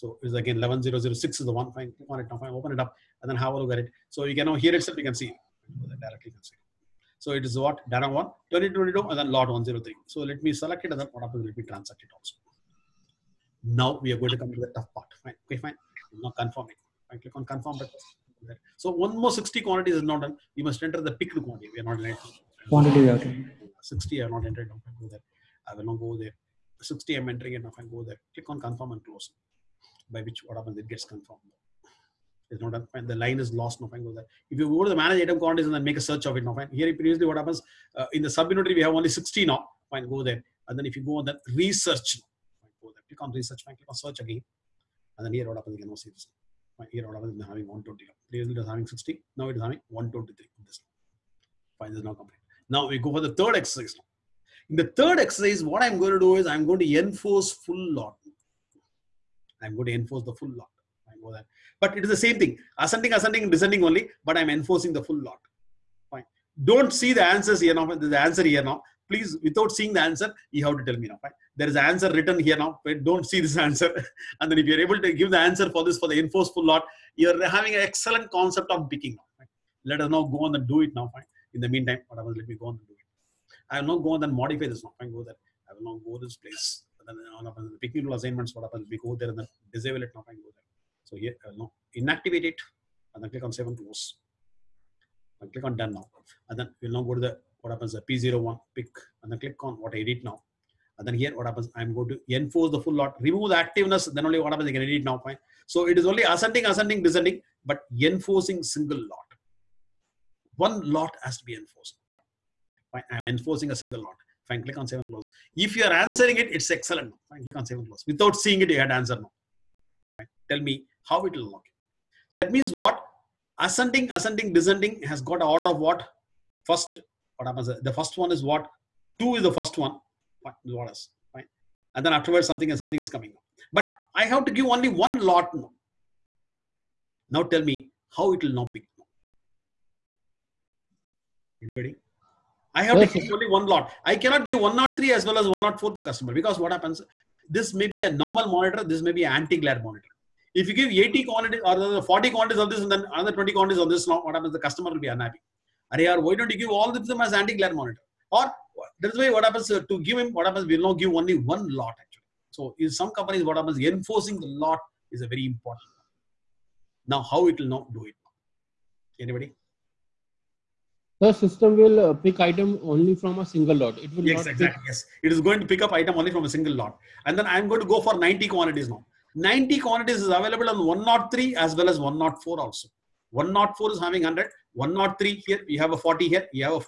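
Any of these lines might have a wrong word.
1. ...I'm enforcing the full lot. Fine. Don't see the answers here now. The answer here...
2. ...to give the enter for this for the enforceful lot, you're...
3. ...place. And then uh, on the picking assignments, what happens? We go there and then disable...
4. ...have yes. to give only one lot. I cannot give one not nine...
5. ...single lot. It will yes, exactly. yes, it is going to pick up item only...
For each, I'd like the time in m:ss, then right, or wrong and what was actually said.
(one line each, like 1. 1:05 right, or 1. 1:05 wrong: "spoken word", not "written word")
1. 1:04 right
2. 1:15 wrong: "answer", not "enter"
3. 1:26 right
4. 2:22 wrong: "three", not "nine"
5. 2:53 right.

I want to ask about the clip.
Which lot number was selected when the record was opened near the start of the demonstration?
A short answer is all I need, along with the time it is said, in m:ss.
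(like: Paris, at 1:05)
103, at 0:09.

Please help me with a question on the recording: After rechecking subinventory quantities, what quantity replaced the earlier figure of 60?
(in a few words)
120.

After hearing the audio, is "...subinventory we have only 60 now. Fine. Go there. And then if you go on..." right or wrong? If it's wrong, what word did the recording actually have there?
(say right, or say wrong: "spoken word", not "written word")
right.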